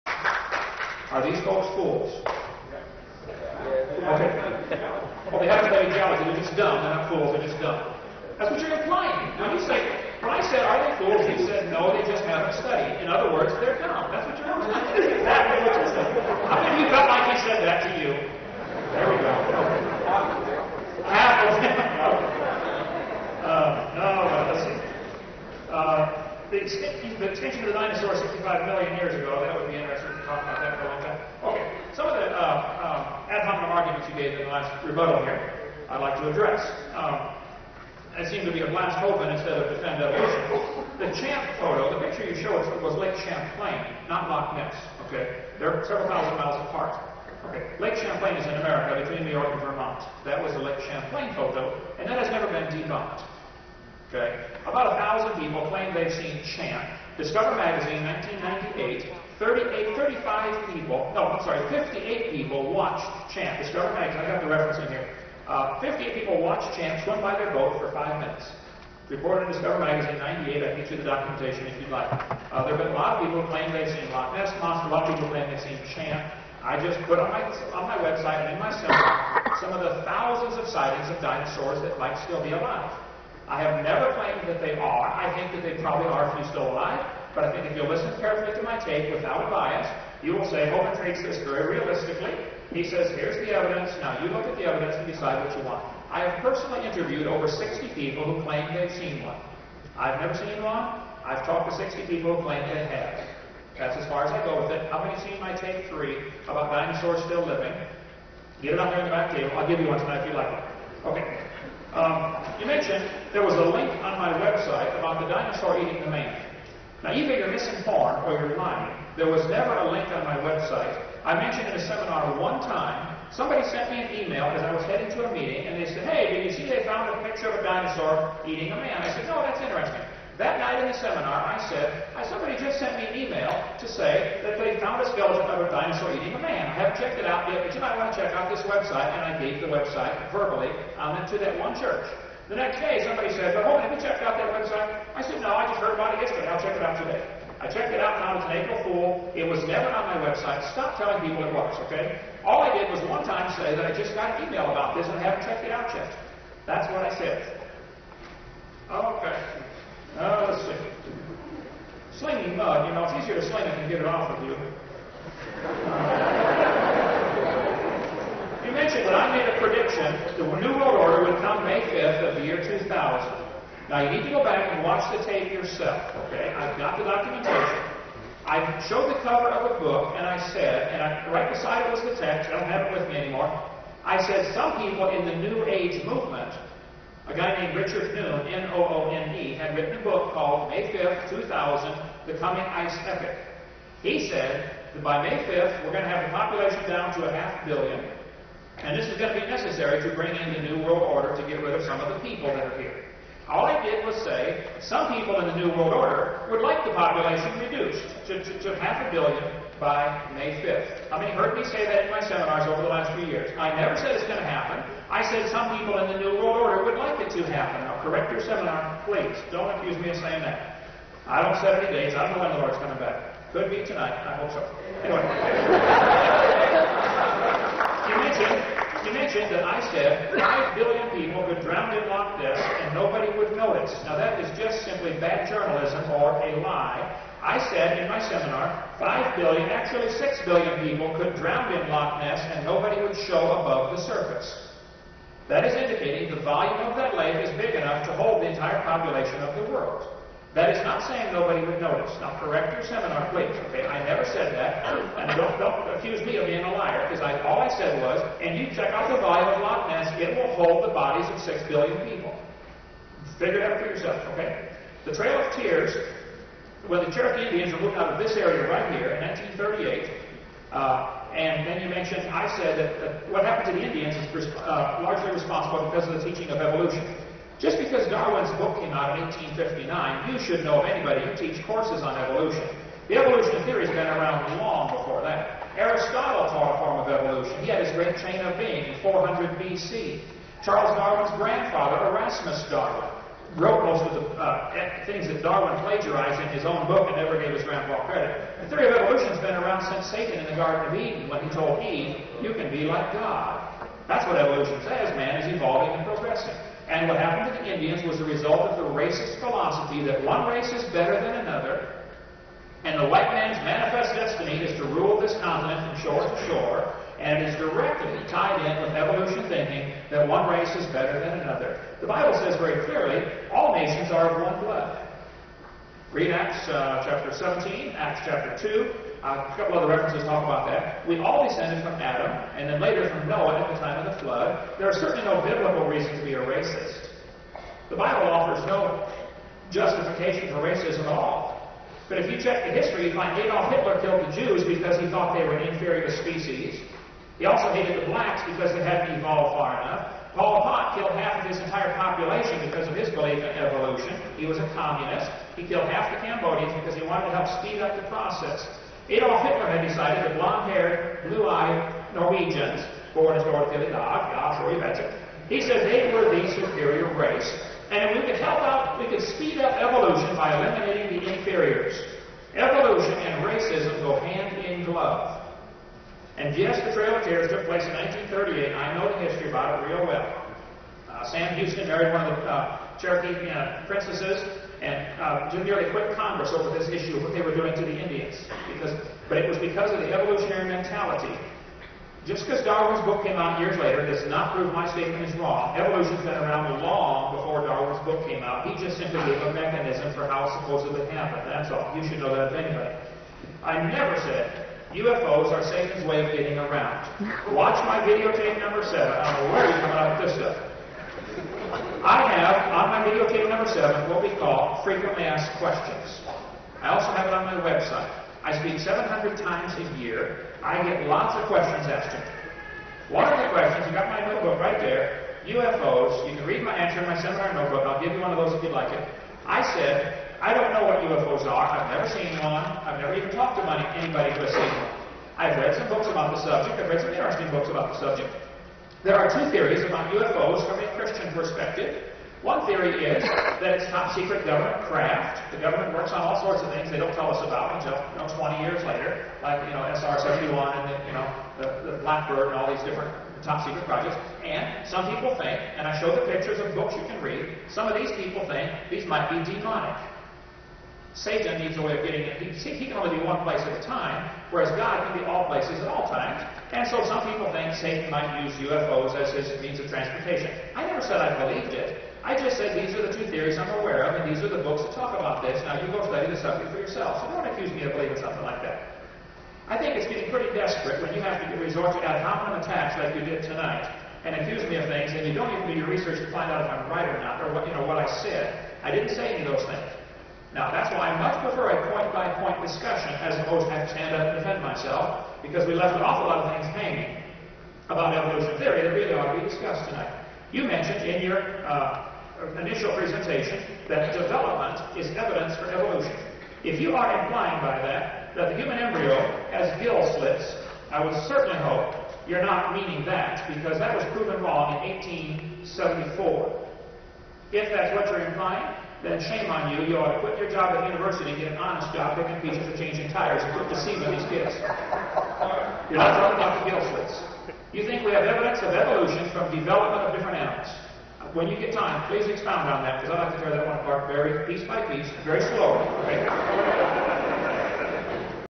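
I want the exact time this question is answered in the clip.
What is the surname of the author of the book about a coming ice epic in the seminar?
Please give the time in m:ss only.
3:07.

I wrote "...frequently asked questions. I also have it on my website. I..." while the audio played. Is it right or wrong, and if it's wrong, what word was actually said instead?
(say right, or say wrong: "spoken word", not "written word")
right.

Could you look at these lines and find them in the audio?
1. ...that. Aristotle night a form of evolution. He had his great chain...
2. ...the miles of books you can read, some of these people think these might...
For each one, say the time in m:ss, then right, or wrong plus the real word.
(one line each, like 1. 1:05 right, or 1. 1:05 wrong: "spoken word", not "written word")
1. 4:45 wrong: "taught", not "night"
2. 7:36 wrong: "pictures", not "miles".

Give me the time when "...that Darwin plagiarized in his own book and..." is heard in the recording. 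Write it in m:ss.
4:55.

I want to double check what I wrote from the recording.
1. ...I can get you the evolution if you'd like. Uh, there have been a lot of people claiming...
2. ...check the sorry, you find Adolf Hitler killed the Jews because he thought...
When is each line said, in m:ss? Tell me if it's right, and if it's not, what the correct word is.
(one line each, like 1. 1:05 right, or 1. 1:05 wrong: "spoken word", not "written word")
1. 1:10 wrong: "documentation", not "evolution"
2. 5:42 wrong: "history", not "sorry".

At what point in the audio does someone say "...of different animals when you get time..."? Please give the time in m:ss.
8:50.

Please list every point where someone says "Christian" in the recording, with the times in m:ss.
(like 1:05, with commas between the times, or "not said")
7:20.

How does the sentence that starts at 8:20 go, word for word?
You mentioned in your uh, initial presentation that development is evidence for evolution.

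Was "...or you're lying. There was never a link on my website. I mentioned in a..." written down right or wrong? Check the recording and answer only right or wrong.
right.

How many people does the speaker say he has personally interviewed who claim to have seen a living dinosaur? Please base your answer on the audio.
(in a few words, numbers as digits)
over 60.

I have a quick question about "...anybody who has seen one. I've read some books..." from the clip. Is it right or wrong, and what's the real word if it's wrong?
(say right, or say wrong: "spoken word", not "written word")
right.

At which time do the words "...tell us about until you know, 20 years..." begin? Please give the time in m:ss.
7:27.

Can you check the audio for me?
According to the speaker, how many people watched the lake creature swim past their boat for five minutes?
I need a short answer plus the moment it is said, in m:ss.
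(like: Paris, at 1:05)
58, at 1:05.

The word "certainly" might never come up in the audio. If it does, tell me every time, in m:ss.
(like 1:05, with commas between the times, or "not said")
5:34, 8:31.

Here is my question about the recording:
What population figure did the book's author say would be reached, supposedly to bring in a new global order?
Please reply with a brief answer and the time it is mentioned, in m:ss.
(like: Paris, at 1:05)
half a billion, at 3:17.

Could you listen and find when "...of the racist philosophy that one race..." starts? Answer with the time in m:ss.
5:08.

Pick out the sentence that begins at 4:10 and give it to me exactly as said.
That is not saying nobody would notice.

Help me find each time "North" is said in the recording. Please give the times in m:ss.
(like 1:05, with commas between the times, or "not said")
6:03.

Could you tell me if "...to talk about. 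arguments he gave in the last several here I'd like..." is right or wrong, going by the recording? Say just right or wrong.
wrong.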